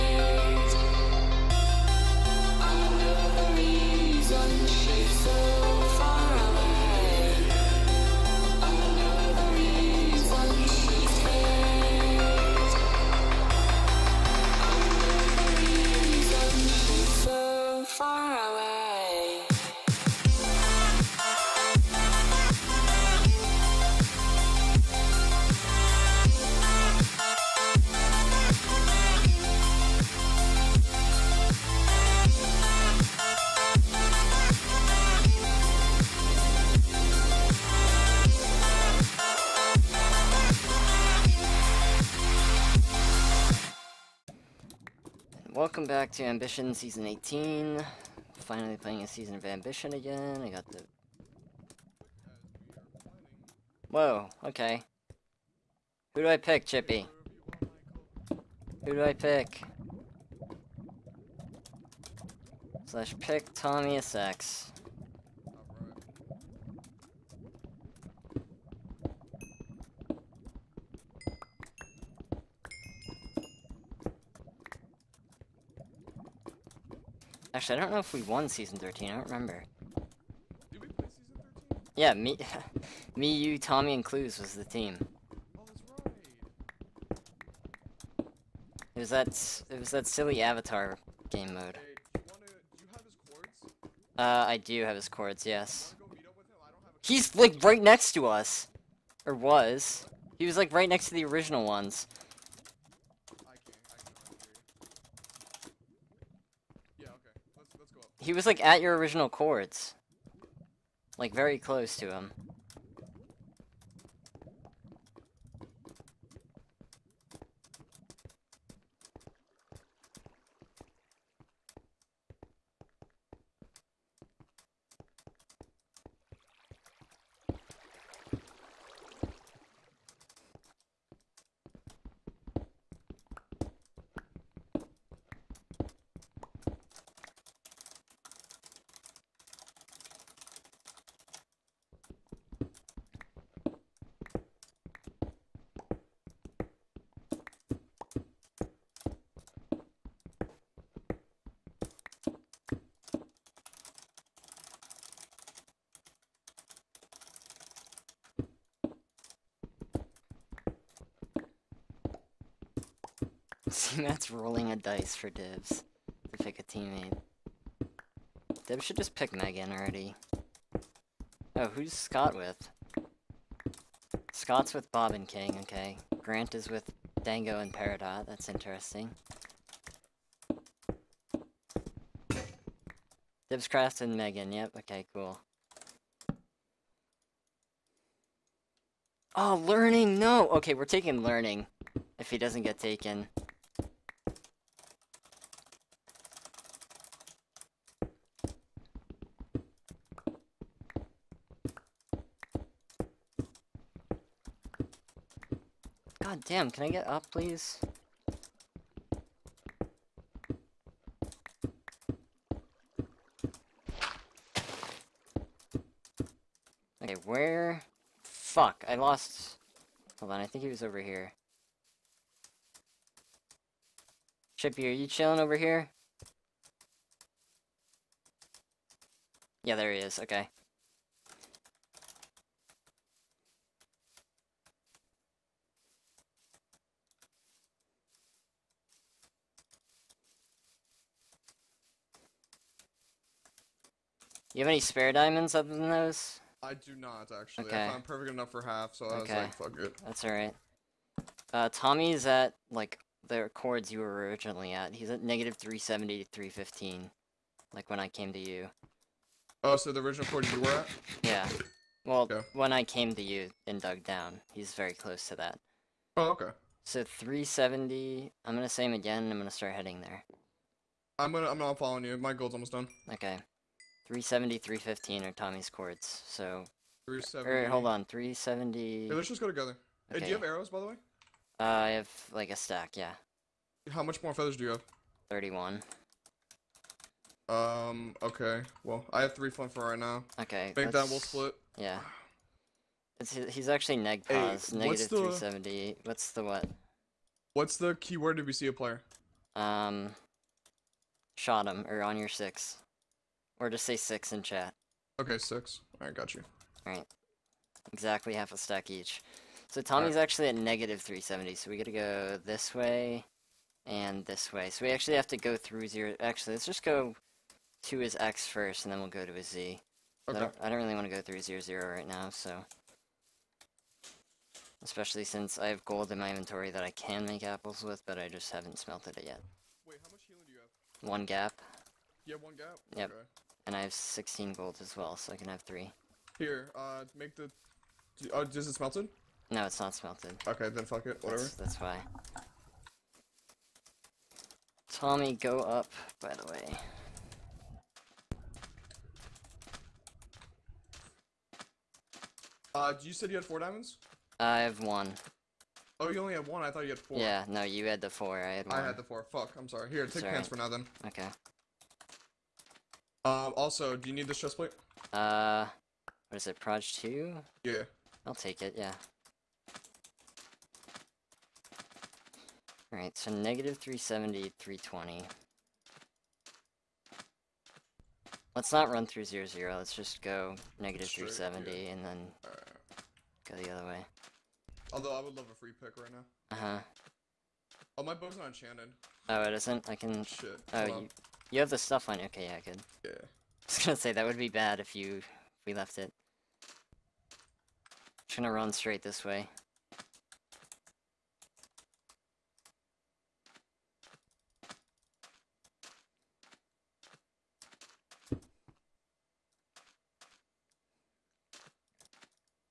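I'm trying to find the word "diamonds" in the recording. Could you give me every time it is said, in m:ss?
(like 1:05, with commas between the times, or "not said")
4:05, 5:53.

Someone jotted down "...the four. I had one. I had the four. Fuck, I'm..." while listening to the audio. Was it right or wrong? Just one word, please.
right.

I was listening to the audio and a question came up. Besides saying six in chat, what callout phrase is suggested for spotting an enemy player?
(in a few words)
on your six.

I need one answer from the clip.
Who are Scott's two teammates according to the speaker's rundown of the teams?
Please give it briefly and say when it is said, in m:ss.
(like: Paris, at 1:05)
Bob and King, at 2:54.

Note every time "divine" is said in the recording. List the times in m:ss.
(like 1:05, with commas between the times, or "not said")
not said.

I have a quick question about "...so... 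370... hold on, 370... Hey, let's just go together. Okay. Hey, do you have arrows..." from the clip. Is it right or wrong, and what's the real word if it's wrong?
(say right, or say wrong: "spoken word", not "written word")
right.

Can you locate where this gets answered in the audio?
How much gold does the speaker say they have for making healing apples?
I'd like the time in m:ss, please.
5:33.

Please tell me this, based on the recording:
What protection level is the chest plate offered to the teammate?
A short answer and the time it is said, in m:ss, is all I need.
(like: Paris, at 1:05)
Prot 2, at 6:06.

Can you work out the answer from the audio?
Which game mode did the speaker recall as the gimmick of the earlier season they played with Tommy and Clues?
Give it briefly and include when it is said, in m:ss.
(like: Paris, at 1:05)
Avatar game mode, at 1:30.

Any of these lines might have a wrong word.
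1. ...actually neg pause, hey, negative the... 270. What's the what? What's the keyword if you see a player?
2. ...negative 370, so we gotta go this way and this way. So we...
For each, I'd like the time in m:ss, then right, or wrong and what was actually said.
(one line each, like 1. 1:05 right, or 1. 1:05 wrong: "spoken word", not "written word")
1. 4:53 wrong: "370", not "270"
2. 5:10 right.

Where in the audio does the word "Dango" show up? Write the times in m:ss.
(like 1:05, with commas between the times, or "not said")
2:57.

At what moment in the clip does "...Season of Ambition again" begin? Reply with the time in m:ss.
0:49.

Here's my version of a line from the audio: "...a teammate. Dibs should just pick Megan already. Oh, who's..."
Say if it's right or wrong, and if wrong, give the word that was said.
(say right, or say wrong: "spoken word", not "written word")
right.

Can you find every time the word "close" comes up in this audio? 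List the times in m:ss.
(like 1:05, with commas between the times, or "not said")
1:51, 4:24.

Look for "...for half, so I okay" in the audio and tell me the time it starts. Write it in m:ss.
4:08.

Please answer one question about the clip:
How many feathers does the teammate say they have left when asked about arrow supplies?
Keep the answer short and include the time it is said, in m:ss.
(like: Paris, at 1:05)
31, at 4:45.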